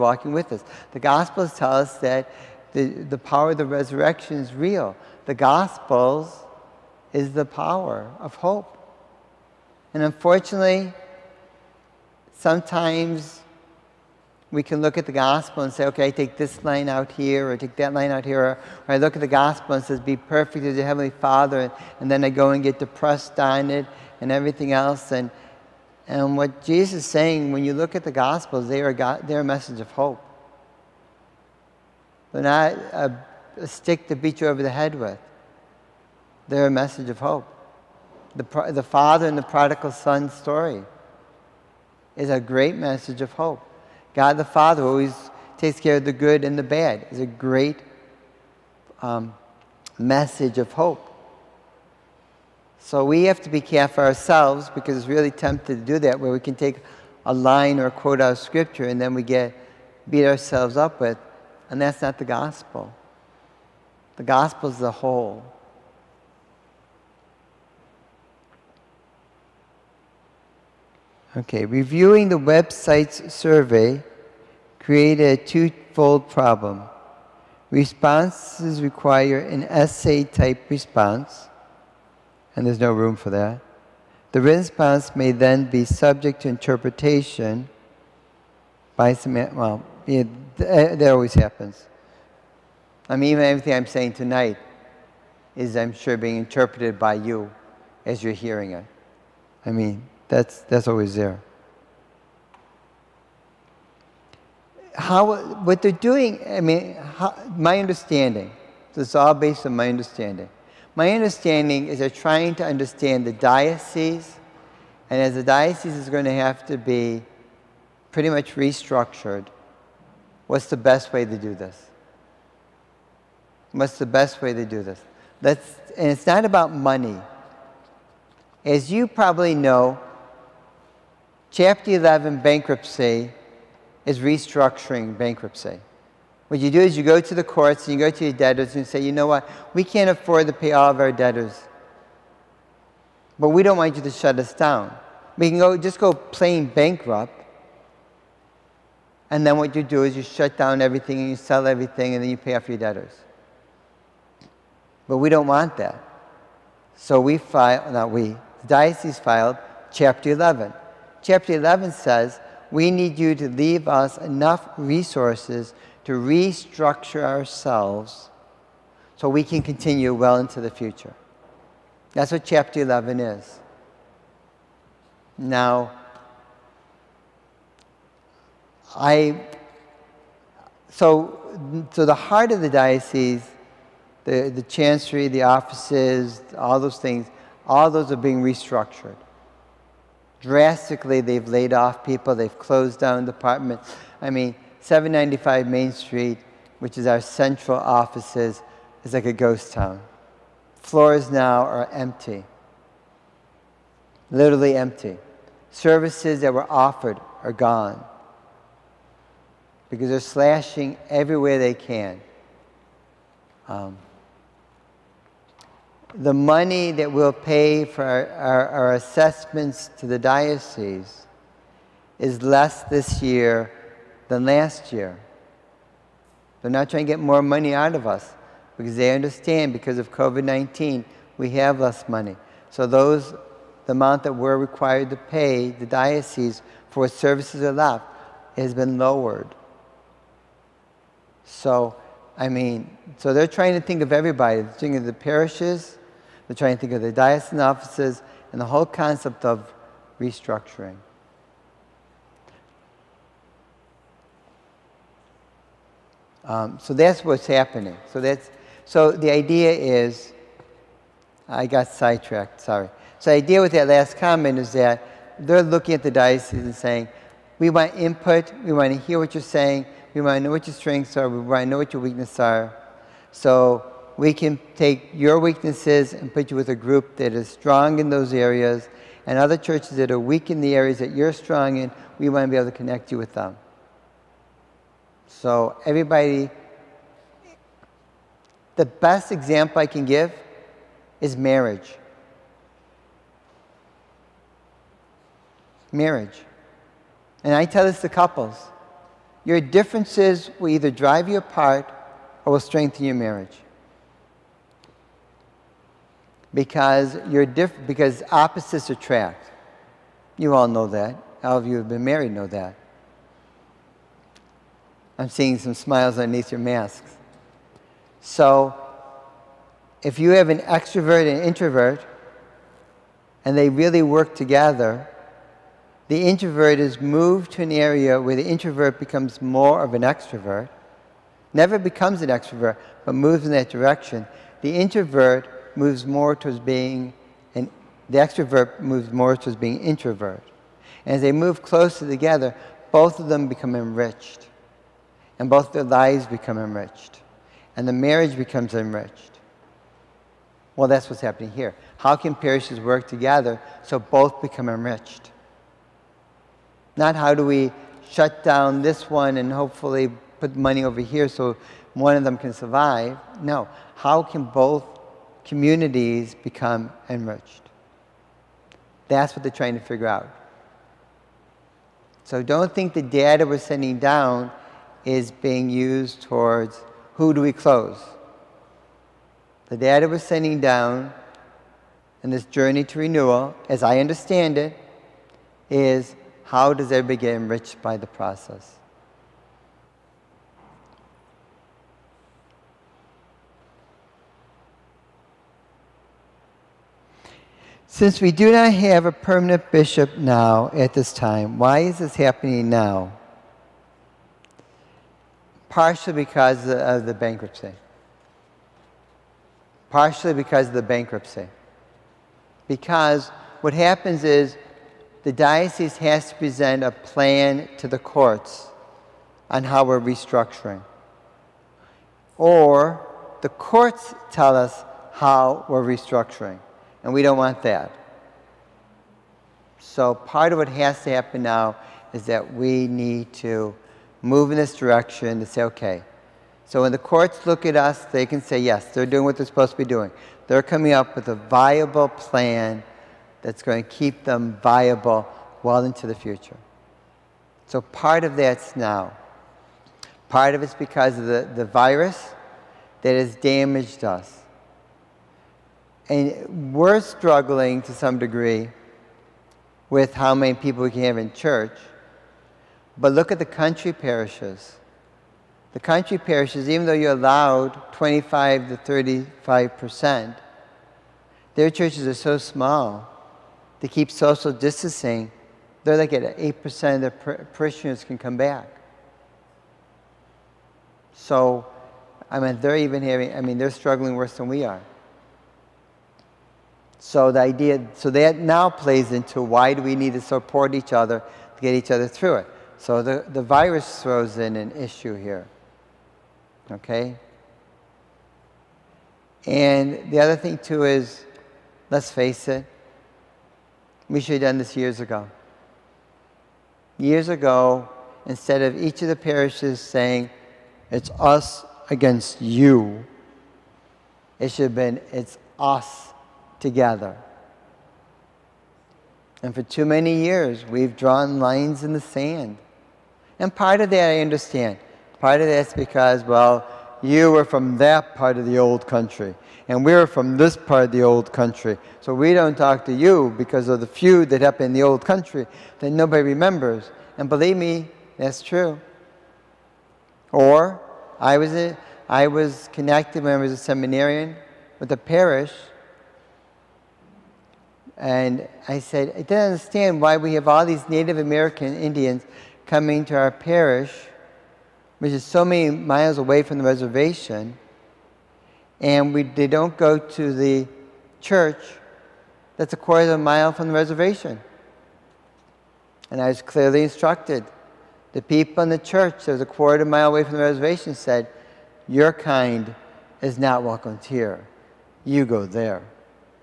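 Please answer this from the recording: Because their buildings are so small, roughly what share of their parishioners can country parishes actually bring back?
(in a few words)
8 percent.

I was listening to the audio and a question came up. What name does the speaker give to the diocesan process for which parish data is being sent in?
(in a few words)
Journey to renewal.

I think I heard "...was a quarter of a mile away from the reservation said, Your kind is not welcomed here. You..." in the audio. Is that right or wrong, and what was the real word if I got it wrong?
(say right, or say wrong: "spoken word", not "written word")
right.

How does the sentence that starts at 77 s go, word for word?
Responses require an essay type response, and there's no room for that.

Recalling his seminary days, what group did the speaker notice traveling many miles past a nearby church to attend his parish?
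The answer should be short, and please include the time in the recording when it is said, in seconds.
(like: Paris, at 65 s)
Native American Indians, at 550 s.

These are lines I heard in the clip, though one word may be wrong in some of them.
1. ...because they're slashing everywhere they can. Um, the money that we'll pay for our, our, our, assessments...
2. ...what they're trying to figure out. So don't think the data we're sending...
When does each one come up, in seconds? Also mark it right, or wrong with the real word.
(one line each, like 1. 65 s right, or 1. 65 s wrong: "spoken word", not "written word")
1. 209 s right
2. 369 s right.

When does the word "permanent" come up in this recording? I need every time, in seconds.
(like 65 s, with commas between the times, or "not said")
399 s.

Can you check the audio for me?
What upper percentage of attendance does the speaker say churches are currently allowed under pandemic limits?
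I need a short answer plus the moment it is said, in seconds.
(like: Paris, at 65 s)
35 percent, at 468 s.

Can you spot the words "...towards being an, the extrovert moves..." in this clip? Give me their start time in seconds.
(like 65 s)
336 s.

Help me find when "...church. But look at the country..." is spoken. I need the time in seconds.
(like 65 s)
461 s.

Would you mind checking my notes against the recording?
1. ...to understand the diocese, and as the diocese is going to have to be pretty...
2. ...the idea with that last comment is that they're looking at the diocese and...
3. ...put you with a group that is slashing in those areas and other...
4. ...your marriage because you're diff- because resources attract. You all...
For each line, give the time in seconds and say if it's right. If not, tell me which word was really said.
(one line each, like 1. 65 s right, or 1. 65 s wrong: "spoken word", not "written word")
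1. 112 s right
2. 263 s right
3. 276 s wrong: "strong", not "slashing"
4. 303 s wrong: "opposites", not "resources".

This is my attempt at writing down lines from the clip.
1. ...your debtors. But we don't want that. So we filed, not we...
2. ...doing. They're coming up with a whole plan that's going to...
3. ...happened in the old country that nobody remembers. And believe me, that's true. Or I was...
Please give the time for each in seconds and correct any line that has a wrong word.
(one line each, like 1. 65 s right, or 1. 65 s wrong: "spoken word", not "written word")
1. 152 s right
2. 439 s wrong: "viable", not "whole"
3. 534 s right.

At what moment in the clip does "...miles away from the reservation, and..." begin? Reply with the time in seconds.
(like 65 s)
555 s.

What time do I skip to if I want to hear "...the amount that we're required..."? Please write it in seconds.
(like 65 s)
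233 s.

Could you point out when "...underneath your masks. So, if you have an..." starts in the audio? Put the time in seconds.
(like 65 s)
316 s.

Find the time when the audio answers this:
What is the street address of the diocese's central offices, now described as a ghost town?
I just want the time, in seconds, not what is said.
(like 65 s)
194 s.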